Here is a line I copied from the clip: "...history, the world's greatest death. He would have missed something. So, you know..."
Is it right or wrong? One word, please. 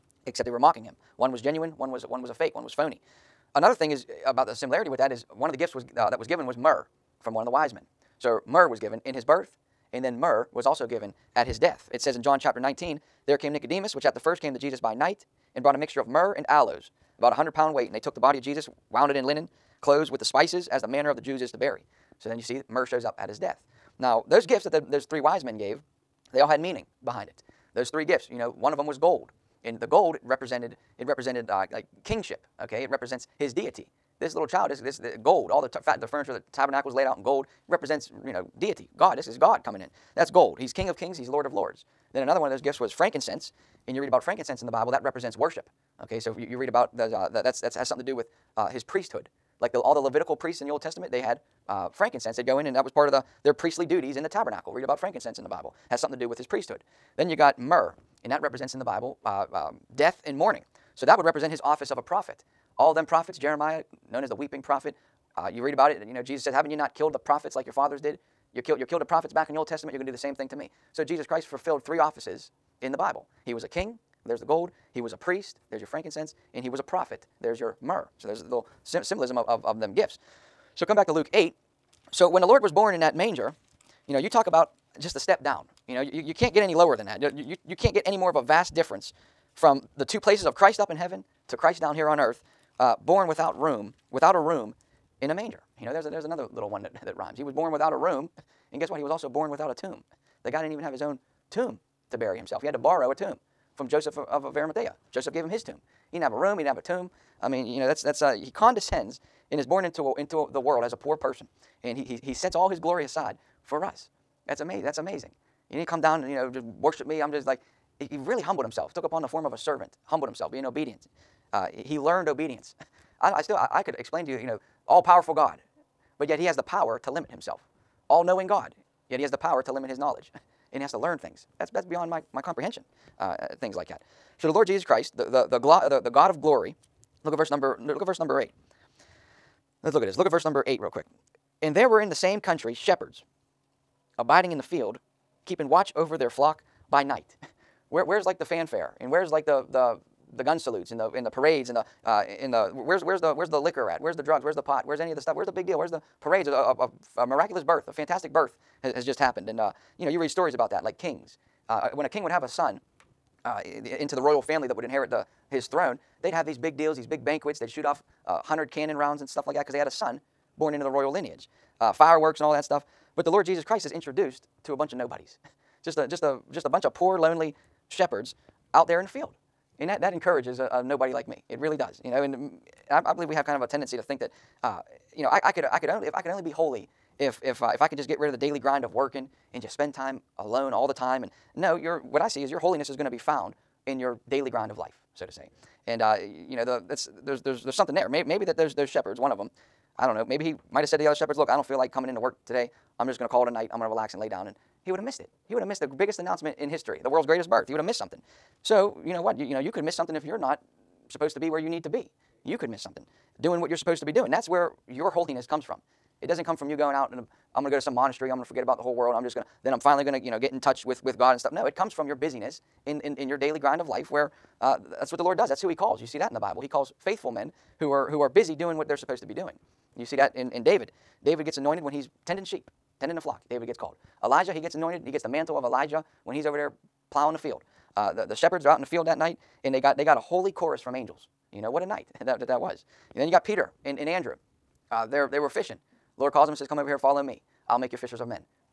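wrong.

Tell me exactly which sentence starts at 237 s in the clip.
Uh, the, the shepherds are out in the field that night, and they got, they got a holy chorus from angels.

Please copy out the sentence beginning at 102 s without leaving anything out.
He had to borrow a tomb from Joseph of, of Arimathea.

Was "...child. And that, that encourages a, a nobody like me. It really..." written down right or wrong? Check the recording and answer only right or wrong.
wrong.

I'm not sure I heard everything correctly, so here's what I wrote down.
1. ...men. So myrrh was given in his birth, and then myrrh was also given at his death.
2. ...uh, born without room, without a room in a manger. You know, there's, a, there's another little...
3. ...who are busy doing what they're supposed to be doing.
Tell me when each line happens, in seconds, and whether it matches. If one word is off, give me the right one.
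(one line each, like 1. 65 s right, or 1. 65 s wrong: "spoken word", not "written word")
1. 7 s right
2. 92 s right
3. 228 s right.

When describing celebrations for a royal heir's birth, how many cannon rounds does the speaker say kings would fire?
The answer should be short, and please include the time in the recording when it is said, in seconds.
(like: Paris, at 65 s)
100, at 168 s.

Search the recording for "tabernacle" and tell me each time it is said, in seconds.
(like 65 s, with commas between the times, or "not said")
36 s, 54 s.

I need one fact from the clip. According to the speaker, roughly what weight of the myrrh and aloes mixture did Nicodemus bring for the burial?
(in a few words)
100 pounds.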